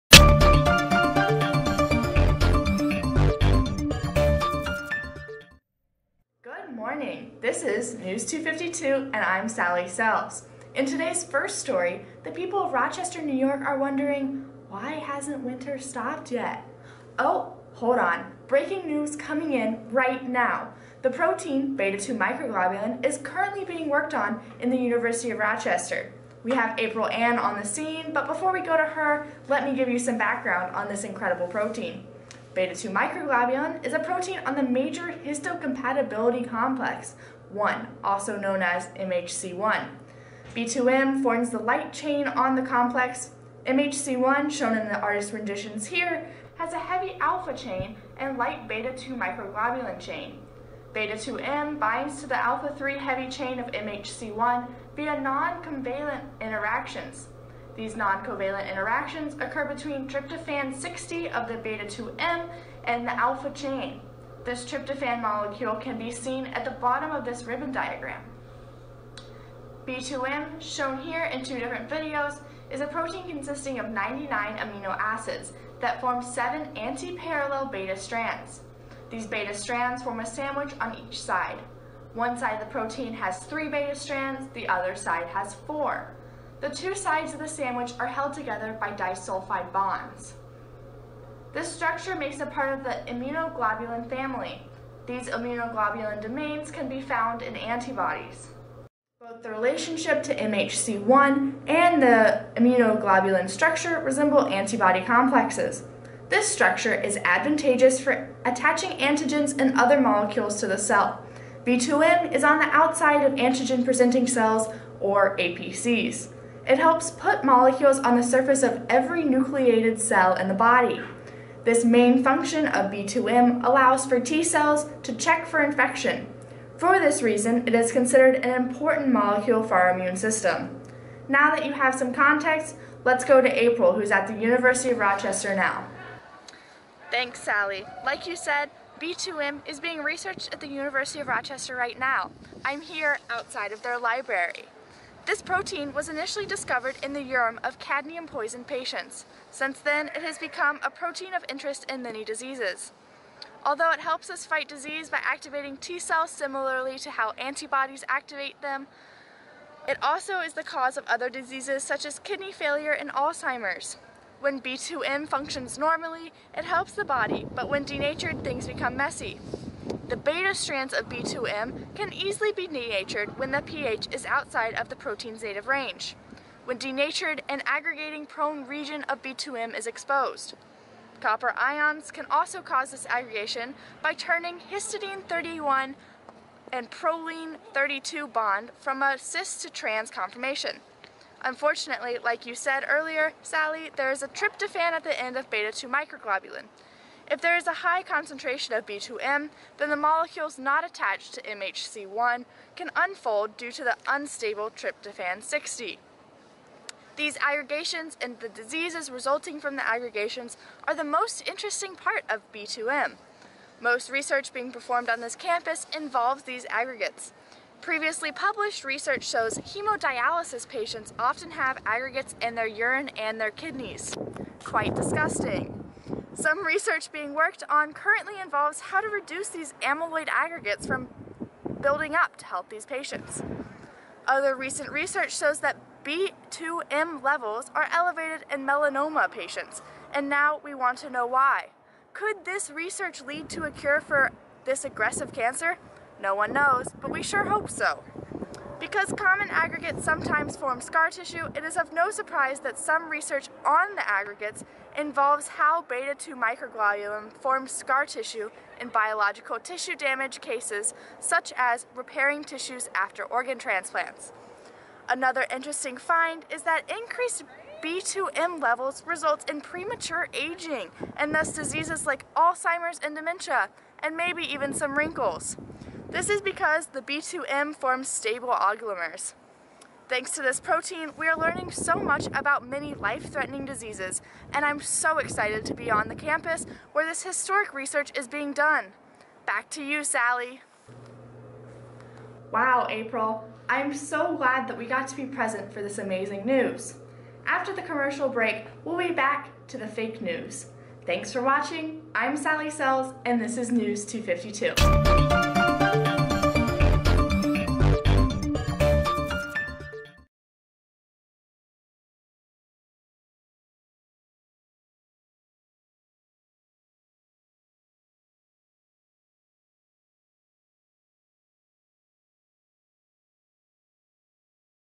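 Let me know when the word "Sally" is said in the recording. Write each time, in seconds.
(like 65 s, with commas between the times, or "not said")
9 s, 137 s, 193 s, 290 s, 302 s.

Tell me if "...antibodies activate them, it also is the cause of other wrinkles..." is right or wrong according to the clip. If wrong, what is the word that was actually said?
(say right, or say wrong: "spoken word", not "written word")
wrong: "diseases", not "wrinkles".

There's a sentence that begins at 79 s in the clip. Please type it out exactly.
These beta strands form a sandwich on each side.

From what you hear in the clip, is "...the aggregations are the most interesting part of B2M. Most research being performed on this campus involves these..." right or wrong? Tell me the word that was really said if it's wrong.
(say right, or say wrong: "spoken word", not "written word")
right.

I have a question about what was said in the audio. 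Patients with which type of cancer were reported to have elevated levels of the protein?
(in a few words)
melanoma.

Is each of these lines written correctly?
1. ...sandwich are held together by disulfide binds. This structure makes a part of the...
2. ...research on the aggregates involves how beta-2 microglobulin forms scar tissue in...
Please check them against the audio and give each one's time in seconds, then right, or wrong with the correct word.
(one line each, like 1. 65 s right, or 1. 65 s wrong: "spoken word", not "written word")
1. 87 s wrong: "bonds", not "binds"
2. 253 s right.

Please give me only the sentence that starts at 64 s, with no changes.
This tryptophan molecule can be seen at the bottom of this ribbon diagram.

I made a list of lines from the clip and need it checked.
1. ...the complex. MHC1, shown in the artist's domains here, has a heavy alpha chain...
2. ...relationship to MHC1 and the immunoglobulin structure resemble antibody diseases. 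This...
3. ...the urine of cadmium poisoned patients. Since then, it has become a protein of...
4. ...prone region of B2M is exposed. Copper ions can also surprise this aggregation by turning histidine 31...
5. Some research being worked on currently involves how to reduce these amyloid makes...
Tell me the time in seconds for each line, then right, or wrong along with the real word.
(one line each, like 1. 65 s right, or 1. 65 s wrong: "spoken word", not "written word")
1. 42 s wrong: "renditions", not "domains"
2. 99 s wrong: "complexes", not "diseases"
3. 147 s right
4. 178 s wrong: "cause", not "surprise"
5. 226 s wrong: "aggregates", not "makes".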